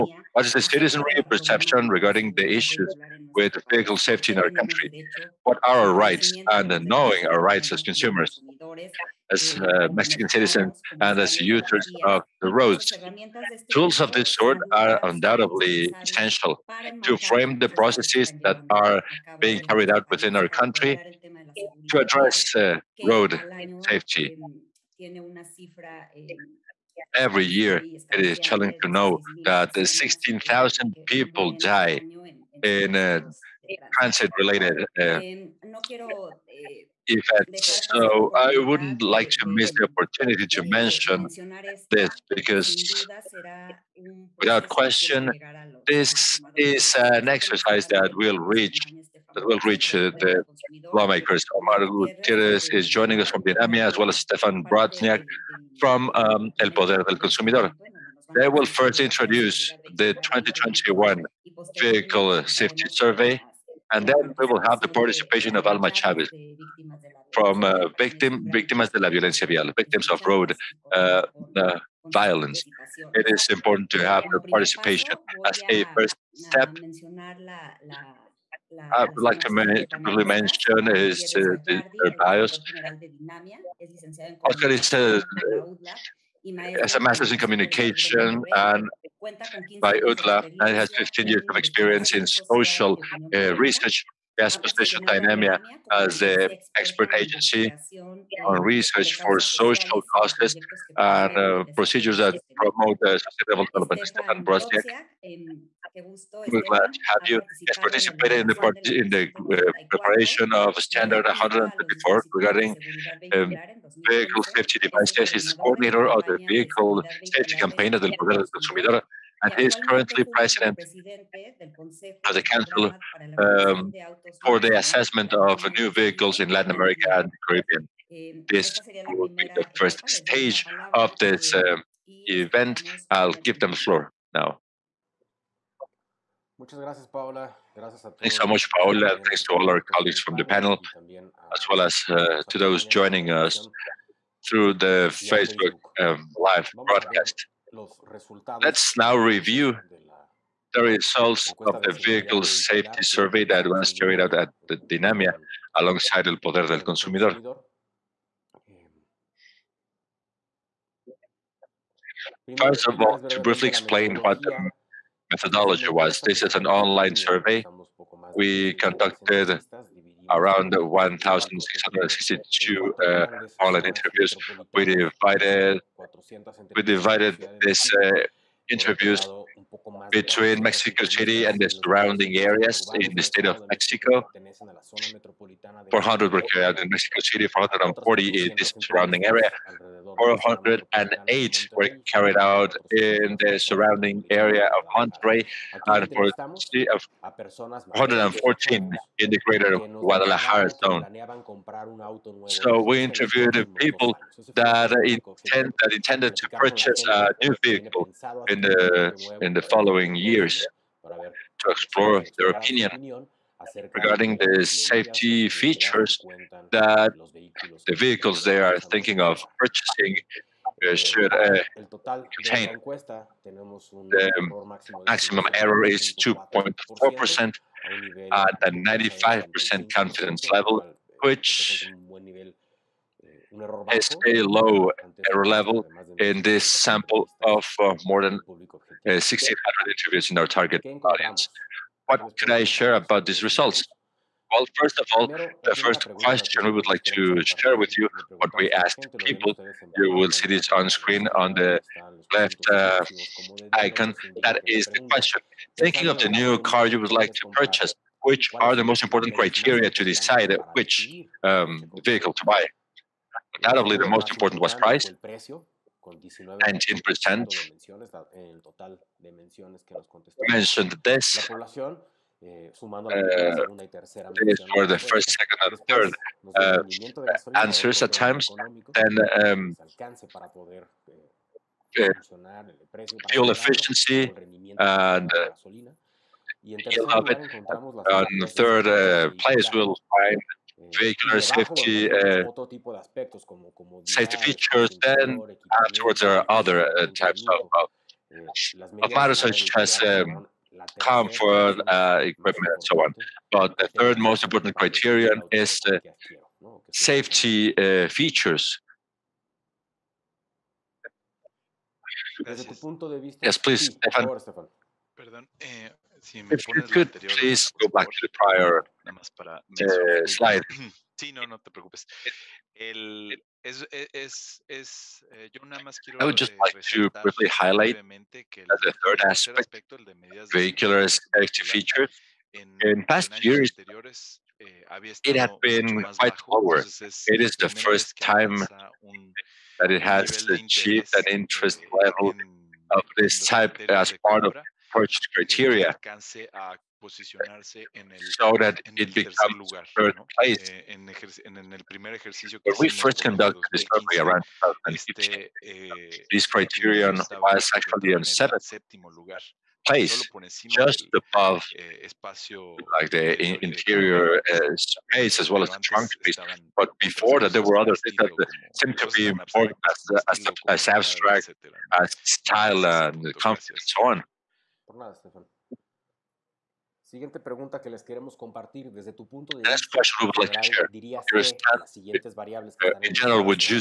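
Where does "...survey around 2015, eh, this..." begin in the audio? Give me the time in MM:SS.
05:53.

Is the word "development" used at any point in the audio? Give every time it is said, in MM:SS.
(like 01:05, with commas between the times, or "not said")
01:43.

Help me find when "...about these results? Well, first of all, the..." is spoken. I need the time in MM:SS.
04:02.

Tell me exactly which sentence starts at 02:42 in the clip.
Eh, First of all, to briefly explain what the methodology was.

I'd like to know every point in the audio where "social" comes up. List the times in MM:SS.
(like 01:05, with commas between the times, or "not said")
01:32, 01:39.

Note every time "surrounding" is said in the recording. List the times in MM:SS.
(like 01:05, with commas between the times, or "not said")
03:01, 03:08, 03:13.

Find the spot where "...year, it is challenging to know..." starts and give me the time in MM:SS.
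00:27.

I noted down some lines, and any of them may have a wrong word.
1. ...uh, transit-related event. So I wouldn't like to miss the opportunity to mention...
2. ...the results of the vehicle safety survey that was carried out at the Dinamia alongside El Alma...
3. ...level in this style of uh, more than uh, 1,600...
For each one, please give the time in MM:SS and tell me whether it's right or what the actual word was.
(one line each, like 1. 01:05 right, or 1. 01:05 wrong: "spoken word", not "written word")
1. 00:32 right
2. 02:30 wrong: "Poder", not "Alma"
3. 03:55 wrong: "sample", not "style".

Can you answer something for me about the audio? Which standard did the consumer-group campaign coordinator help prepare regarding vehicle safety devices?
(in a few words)
Standard 134.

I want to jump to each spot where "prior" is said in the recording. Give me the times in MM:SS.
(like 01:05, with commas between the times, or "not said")
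05:18.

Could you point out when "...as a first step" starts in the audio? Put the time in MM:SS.
01:15.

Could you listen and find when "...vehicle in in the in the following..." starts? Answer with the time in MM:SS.
03:27.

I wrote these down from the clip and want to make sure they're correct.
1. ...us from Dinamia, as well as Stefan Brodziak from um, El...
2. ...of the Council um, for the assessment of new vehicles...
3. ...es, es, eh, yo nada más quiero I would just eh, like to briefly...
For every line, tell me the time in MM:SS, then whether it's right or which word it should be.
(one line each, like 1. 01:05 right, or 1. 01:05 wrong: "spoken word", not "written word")
1. 00:53 right
2. 02:02 right
3. 05:23 right.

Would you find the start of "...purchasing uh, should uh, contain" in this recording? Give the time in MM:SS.
03:39.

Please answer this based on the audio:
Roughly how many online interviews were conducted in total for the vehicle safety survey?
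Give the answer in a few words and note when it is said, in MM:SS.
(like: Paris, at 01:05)
1,662, at 02:50.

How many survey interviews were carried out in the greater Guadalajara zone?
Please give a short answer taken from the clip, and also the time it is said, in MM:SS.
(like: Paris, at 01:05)
114, at 03:16.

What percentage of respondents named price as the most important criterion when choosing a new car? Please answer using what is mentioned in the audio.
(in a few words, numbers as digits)
19%.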